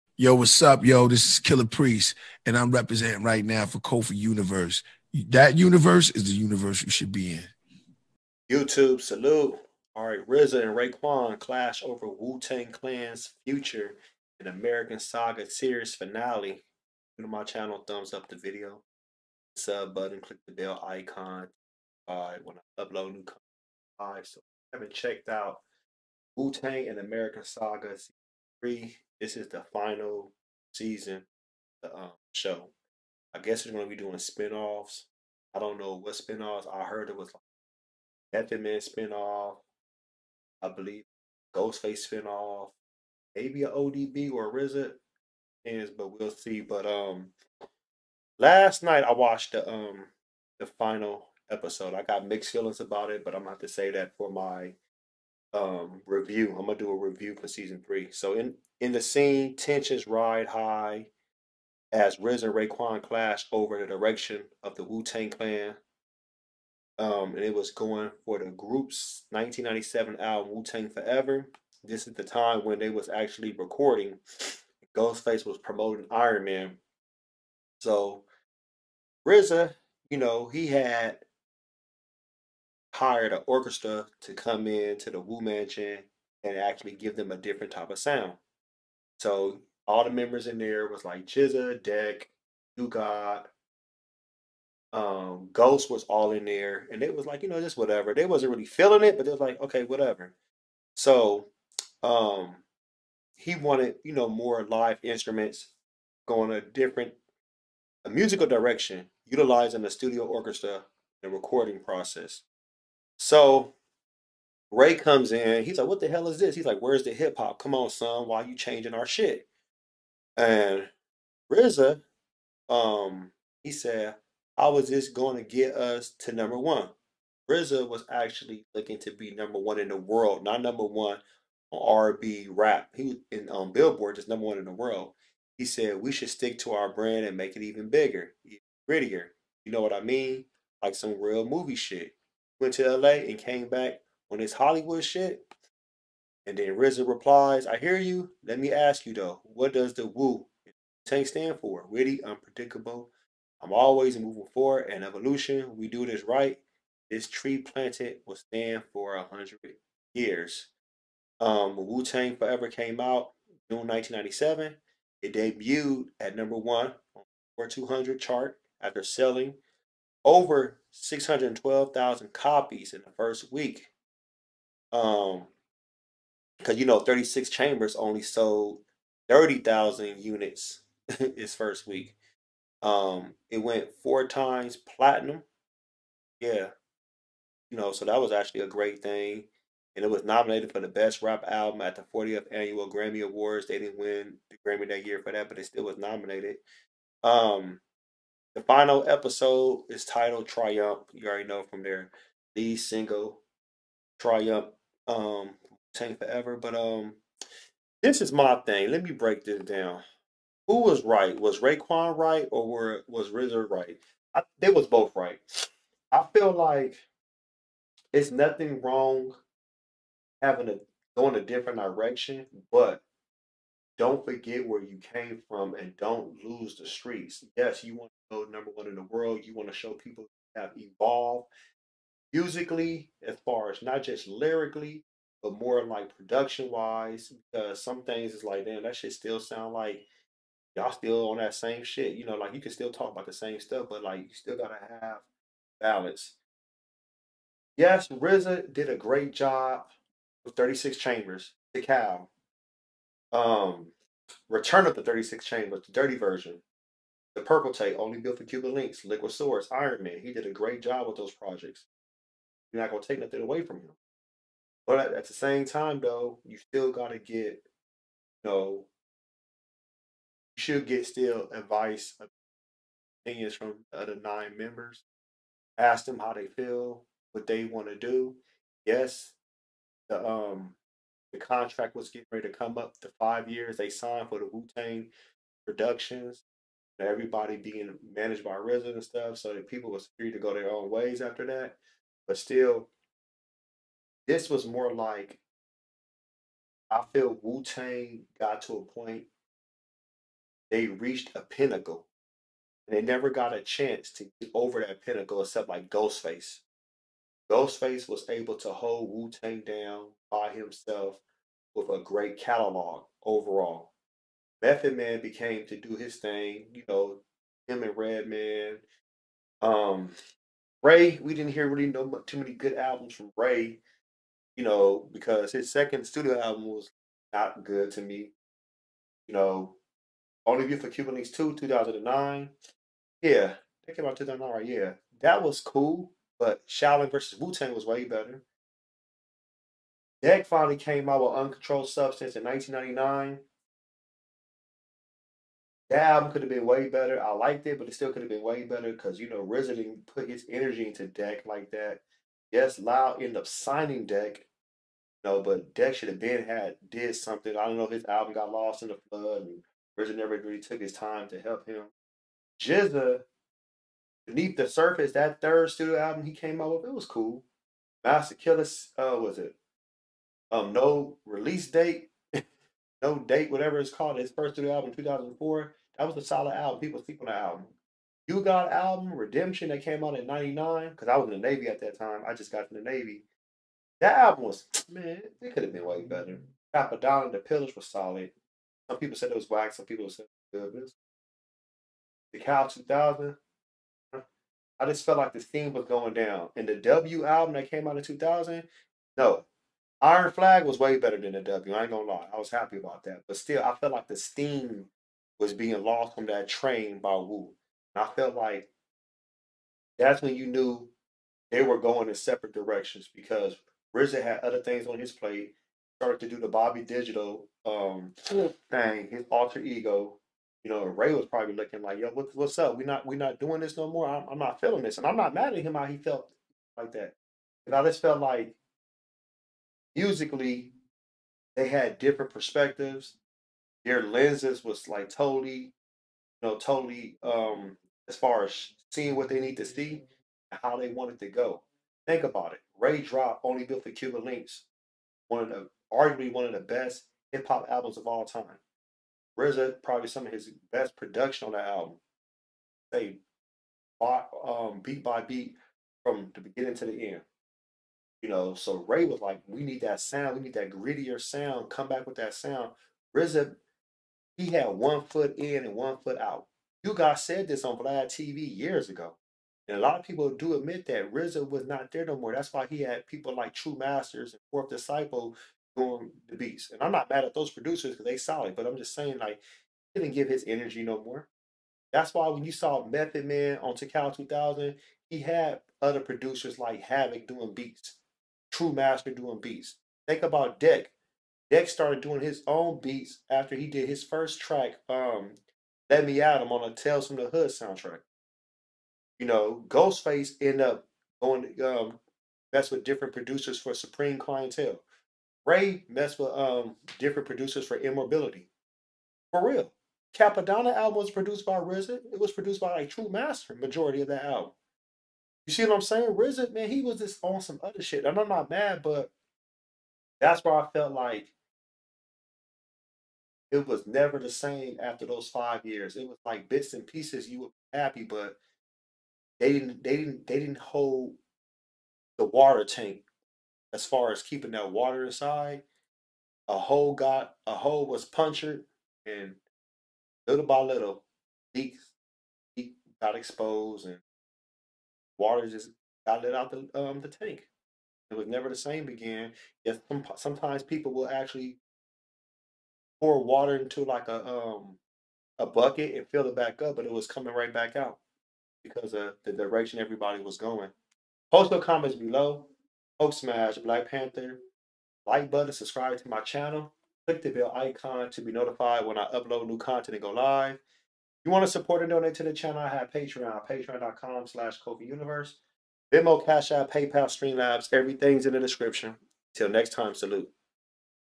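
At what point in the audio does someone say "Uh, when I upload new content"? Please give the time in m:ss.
0:22.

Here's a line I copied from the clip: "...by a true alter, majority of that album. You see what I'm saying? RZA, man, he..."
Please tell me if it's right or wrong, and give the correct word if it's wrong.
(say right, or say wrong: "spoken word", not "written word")
wrong: "master", not "alter".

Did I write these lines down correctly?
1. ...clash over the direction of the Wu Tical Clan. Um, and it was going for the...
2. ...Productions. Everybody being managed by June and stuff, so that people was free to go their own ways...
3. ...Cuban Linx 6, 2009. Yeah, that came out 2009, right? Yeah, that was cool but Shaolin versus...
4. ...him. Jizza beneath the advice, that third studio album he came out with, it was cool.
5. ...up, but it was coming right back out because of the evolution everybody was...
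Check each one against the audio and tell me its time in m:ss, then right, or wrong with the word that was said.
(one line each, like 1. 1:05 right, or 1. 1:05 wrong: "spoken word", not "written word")
1. 1:03 wrong: "Tang", not "Tical"
2. 4:45 wrong: "RZA", not "June"
3. 5:30 wrong: "2", not "6"
4. 6:01 wrong: "surface", not "advice"
5. 9:16 wrong: "direction", not "evolution".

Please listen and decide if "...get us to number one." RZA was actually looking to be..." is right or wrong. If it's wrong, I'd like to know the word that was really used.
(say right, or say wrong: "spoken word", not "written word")
right.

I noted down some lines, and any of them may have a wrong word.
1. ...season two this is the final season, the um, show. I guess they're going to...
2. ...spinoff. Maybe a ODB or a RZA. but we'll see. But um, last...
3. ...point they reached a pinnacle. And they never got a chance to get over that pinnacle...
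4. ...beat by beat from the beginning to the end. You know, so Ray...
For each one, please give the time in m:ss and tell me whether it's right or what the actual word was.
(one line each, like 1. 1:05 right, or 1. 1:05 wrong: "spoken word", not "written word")
1. 0:27 wrong: "three", not "two"
2. 0:42 right
3. 4:58 right
4. 7:34 right.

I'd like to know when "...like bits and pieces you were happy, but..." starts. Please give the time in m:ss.
8:46.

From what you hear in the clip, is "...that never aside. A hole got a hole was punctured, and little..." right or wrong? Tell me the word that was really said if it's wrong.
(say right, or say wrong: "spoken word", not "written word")
wrong: "water", not "never".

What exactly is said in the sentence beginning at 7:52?
That's why he had people like True Masters and Fourth Disciple doing the beats.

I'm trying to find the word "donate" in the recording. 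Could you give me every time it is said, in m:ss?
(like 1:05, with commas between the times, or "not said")
9:31.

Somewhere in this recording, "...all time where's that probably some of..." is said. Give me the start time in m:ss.
7:28.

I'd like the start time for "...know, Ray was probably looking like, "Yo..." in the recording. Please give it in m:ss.
7:00.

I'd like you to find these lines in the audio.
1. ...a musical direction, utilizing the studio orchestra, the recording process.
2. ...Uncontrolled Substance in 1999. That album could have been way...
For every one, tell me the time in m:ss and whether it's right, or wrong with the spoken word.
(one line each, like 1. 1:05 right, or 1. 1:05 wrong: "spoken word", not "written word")
1. 1:48 right
2. 5:41 right.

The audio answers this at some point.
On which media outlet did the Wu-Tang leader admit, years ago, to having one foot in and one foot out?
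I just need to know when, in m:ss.
7:47.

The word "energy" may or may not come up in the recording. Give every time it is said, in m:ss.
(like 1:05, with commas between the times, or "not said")
5:50, 8:00.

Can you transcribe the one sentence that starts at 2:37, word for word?
This tree planted will stand for a hundred years.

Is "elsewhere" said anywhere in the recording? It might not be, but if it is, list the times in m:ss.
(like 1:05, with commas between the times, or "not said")
not said.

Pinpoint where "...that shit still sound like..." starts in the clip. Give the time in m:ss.
3:58.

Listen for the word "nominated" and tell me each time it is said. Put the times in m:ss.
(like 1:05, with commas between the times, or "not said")
3:10, 3:15.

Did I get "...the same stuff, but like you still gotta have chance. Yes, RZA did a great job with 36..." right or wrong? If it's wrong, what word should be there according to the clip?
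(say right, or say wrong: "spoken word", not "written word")
wrong: "balance", not "chance".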